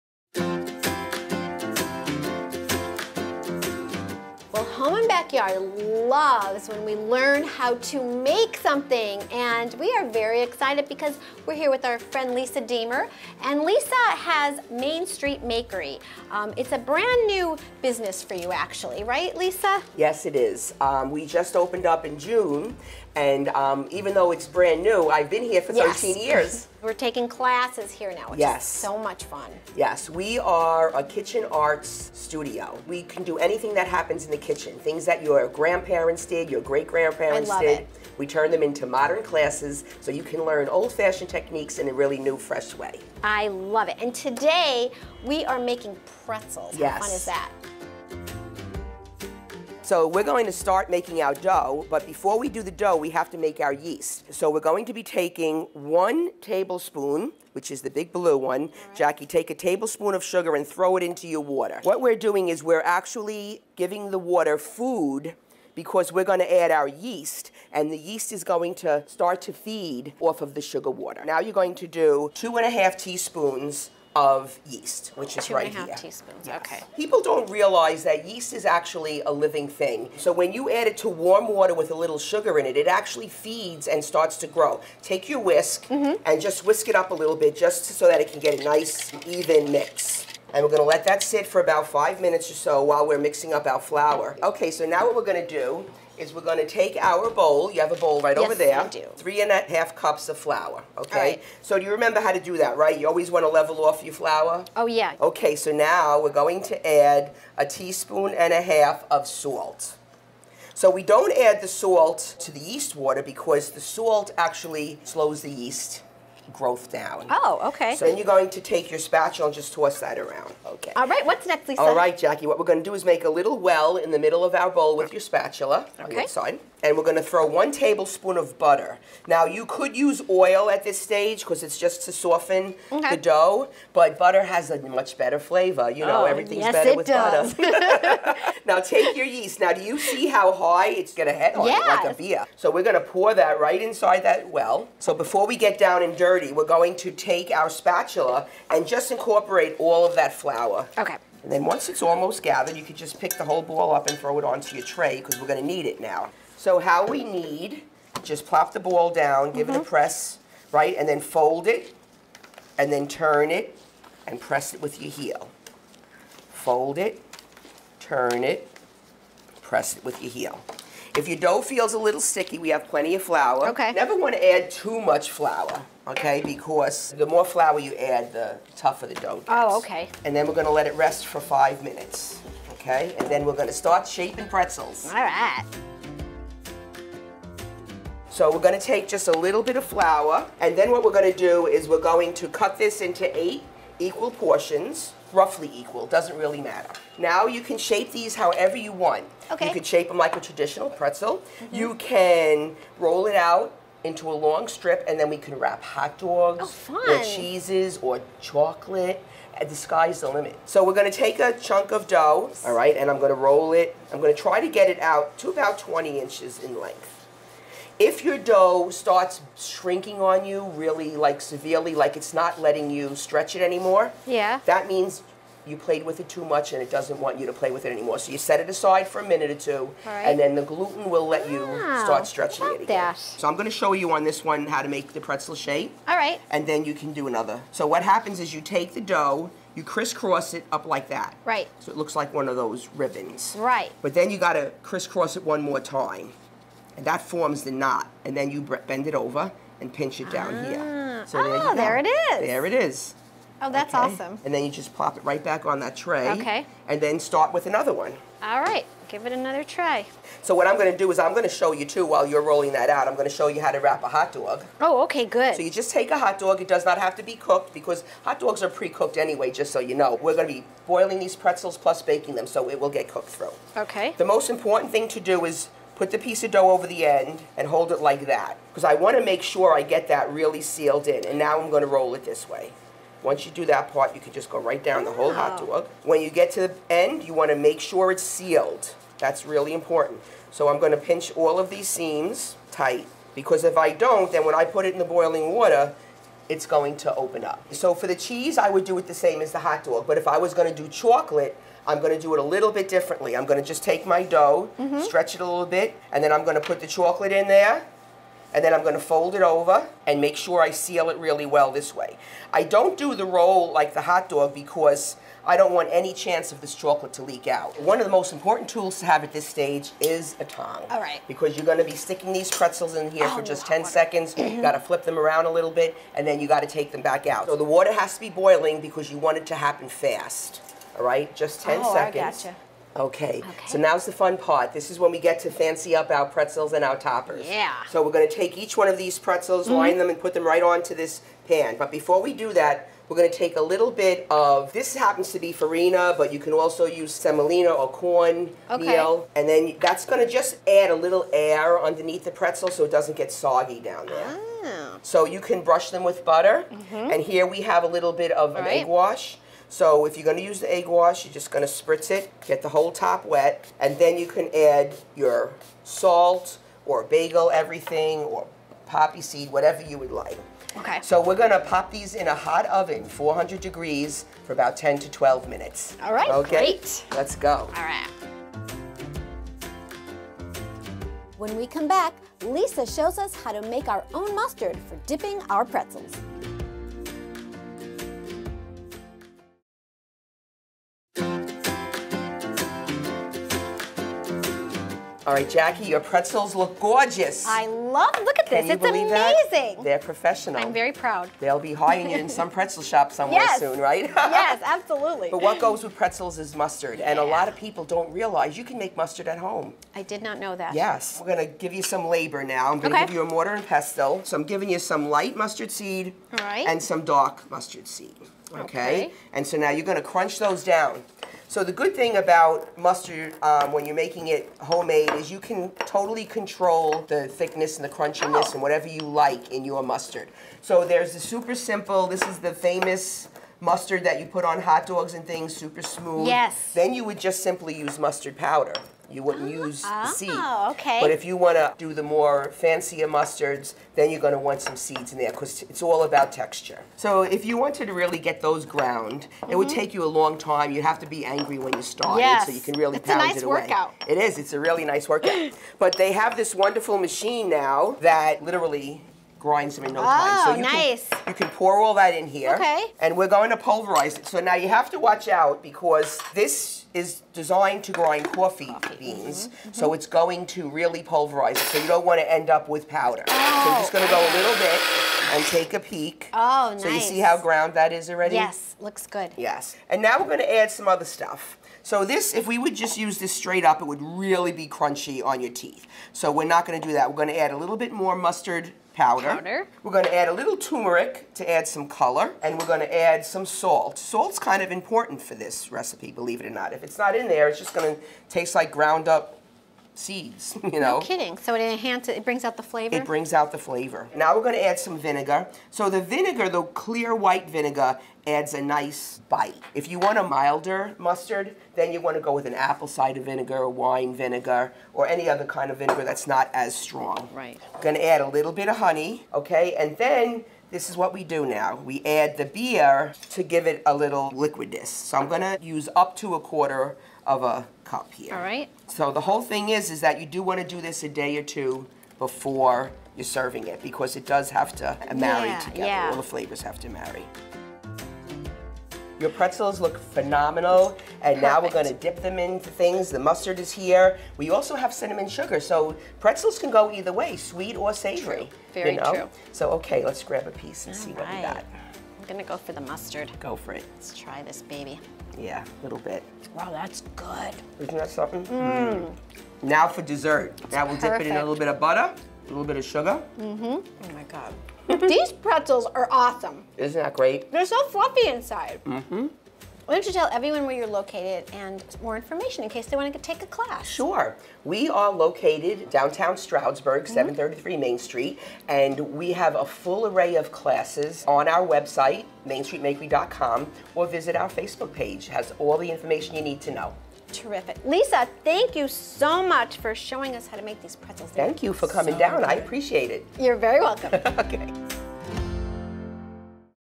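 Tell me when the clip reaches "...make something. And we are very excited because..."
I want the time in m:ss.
0:08.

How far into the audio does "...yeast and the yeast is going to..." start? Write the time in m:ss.
1:06.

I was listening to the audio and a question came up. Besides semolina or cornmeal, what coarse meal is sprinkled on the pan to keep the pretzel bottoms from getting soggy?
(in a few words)
farina.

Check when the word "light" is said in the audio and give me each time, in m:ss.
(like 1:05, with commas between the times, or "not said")
6:55.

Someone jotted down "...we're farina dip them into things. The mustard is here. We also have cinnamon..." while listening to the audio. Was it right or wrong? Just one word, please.
wrong.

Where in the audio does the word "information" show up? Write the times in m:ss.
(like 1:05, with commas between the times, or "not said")
9:32, 9:45.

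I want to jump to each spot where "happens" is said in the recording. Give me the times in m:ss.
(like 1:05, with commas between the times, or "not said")
0:33, 3:58, 5:29, 5:44.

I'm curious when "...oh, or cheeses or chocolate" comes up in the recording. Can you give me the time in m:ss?
3:26.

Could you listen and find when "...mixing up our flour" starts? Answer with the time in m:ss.
1:33.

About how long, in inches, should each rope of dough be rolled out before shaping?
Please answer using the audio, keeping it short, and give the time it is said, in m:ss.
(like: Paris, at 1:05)
20 inches, at 3:35.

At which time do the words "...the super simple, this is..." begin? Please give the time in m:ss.
7:11.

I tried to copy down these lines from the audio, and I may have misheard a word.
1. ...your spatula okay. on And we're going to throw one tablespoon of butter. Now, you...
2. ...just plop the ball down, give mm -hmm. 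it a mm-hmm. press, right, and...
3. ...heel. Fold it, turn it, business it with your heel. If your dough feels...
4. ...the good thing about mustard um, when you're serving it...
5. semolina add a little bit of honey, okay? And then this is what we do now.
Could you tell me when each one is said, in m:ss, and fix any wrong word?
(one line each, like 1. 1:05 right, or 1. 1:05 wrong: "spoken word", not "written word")
1. 2:05 right
2. 2:38 right
3. 2:45 wrong: "press", not "business"
4. 7:01 wrong: "making", not "serving"
5. 8:37 wrong: "gonna", not "semolina".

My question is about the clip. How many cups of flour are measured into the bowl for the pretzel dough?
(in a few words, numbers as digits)
3.5.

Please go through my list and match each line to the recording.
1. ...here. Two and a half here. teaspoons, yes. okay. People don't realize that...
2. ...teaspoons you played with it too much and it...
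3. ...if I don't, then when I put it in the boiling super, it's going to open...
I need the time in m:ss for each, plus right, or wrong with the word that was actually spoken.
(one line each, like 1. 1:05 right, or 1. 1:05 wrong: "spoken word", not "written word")
1. 1:15 right
2. 3:44 wrong: "means", not "teaspoons"
3. 4:53 wrong: "water", not "super".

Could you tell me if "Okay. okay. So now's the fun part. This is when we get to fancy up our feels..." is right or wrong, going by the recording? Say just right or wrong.
wrong.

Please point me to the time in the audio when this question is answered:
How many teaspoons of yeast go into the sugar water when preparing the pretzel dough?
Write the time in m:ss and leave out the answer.
1:12.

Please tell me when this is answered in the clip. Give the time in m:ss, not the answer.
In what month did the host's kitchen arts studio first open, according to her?
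0:22.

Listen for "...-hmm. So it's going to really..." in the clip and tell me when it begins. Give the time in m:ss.
7:49.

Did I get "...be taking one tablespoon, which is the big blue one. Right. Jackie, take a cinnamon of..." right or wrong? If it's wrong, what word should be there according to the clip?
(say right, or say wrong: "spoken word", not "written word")
wrong: "tablespoon", not "cinnamon".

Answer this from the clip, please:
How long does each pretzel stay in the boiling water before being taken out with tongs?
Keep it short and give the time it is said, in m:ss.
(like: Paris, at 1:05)
10 seconds, at 5:23.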